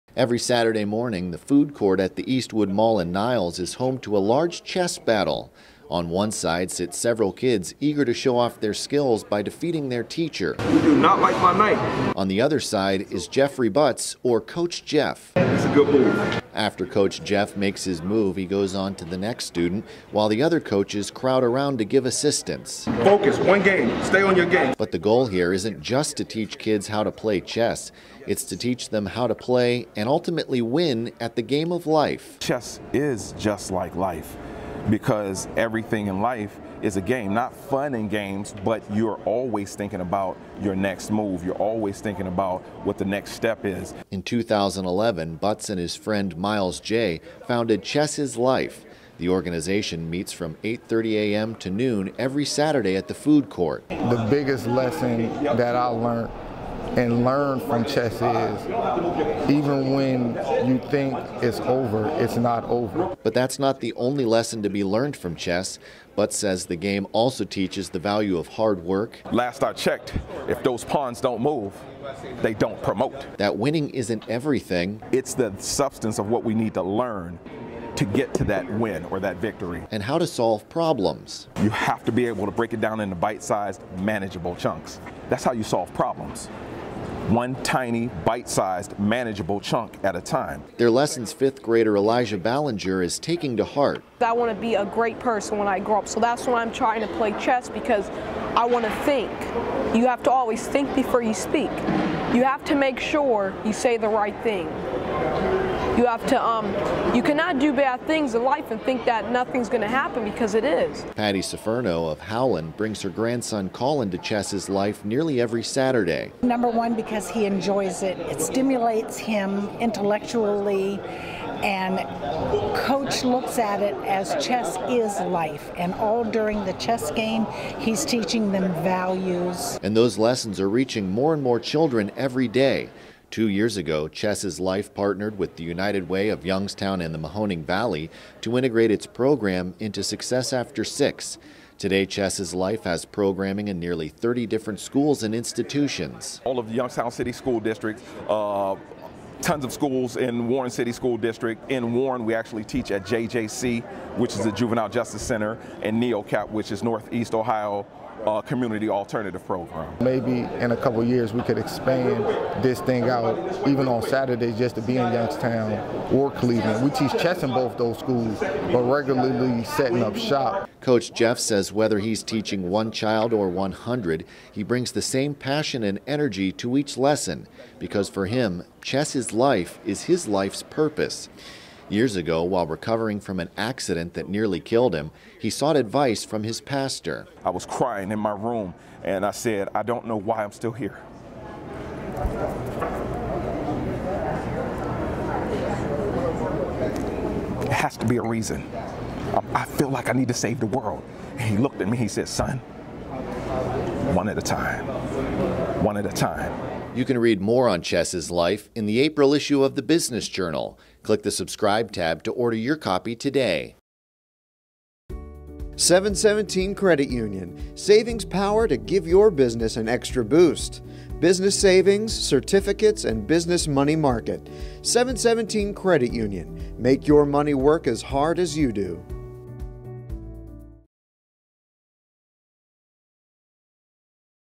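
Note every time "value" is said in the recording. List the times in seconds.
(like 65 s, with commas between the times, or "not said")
67 s, 128 s.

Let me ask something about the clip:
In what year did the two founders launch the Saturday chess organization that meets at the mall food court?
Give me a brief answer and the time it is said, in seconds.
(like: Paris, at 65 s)
2011, at 44 s.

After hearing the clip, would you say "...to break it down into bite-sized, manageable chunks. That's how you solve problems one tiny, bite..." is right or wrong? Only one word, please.
right.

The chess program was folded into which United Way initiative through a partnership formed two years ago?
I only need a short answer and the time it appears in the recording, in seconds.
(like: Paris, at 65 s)
Success After Six, at 140 s.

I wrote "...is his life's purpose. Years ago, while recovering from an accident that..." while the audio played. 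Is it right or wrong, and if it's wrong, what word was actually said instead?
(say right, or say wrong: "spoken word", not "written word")
right.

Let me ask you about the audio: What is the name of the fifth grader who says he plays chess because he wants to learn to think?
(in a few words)
Elijah Ballinger.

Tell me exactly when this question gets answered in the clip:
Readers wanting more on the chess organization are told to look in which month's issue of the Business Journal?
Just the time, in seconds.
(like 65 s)
208 s.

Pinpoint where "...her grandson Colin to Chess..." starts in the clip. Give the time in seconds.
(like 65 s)
113 s.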